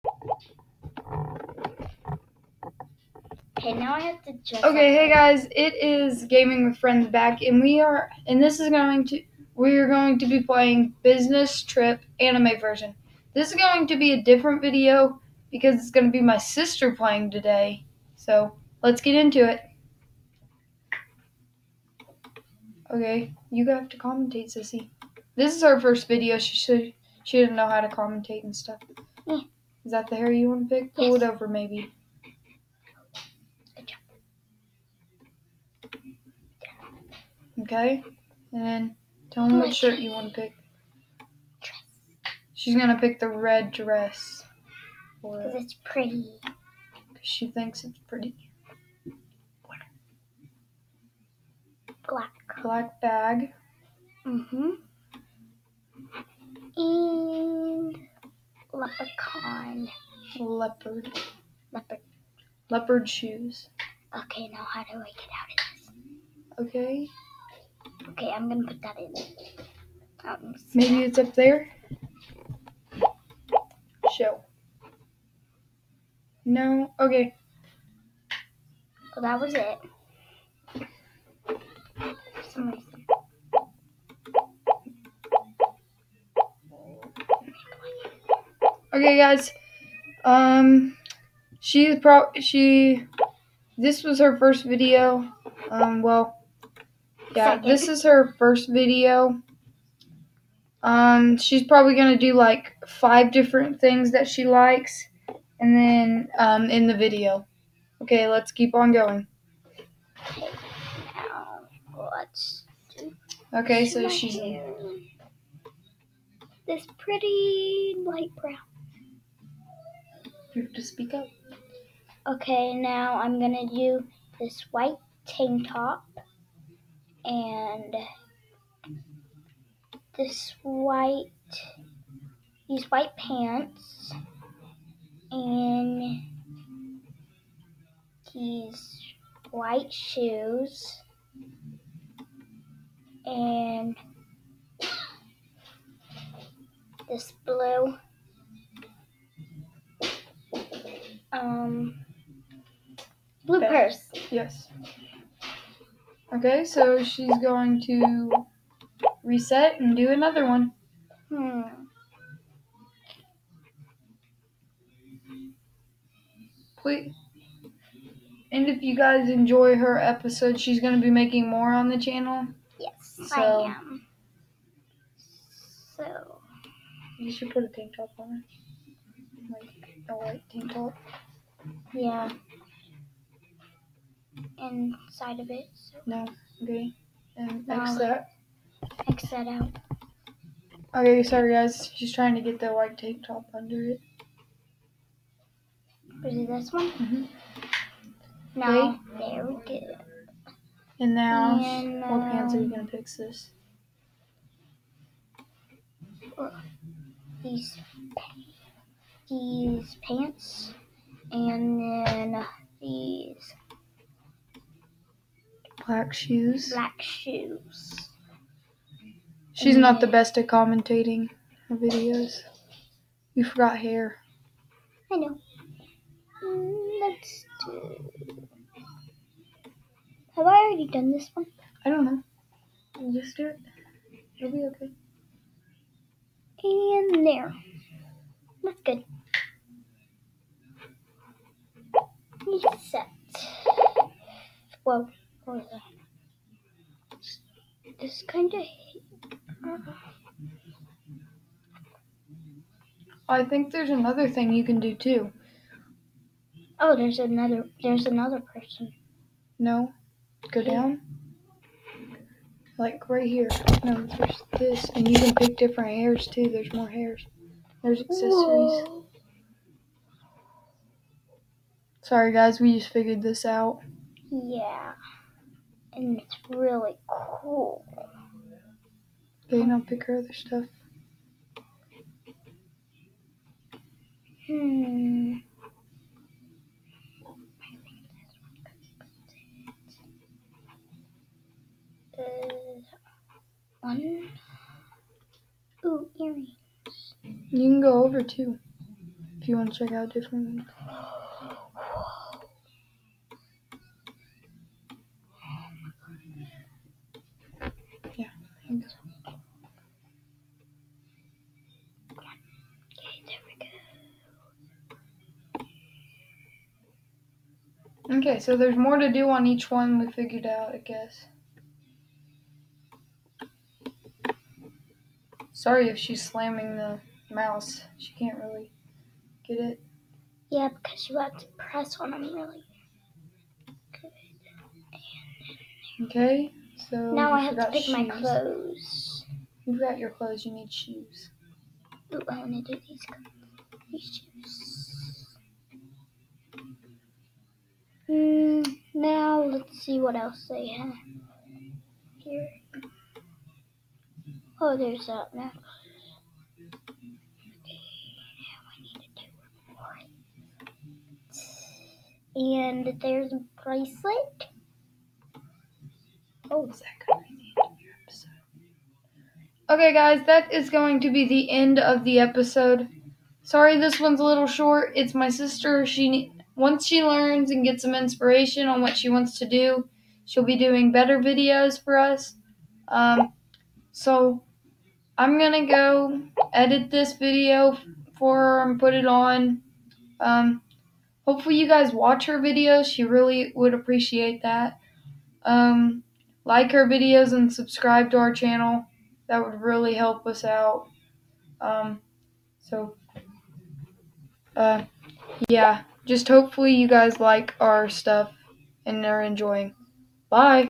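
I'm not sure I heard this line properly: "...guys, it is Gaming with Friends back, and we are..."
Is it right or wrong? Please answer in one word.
right.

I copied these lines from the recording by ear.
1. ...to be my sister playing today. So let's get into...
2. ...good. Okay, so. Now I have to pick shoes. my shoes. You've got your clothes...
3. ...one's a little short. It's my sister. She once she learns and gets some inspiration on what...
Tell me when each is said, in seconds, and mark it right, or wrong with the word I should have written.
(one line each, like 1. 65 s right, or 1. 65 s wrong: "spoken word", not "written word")
1. 16 s right
2. 333 s wrong: "clothes", not "shoes"
3. 373 s right.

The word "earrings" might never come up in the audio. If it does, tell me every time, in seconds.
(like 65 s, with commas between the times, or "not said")
296 s.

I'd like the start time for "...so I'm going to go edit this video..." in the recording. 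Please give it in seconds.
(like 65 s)
383 s.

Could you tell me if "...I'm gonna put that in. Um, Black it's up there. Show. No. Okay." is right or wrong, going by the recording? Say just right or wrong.
wrong.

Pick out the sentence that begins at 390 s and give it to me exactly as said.
Um, hopefully you guys watch her videos.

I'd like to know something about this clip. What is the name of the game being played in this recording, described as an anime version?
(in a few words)
Business Trip.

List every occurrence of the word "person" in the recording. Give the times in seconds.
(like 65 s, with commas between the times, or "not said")
258 s.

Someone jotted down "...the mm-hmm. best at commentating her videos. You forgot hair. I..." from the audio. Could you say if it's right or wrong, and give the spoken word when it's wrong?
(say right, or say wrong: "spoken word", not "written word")
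right.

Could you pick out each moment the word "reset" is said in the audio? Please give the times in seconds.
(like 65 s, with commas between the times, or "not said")
159 s, 242 s.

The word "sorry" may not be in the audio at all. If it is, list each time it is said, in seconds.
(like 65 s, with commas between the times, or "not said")
191 s, 272 s, 325 s, 373 s.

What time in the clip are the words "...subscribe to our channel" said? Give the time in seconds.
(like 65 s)
397 s.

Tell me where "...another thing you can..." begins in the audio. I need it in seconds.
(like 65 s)
253 s.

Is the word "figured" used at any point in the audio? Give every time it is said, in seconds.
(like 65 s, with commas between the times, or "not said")
272 s, 320 s.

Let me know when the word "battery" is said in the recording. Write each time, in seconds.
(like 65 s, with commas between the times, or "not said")
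not said.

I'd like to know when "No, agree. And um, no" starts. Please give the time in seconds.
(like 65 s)
186 s.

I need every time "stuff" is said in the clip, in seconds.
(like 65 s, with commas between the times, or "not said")
28 s, 280 s, 407 s.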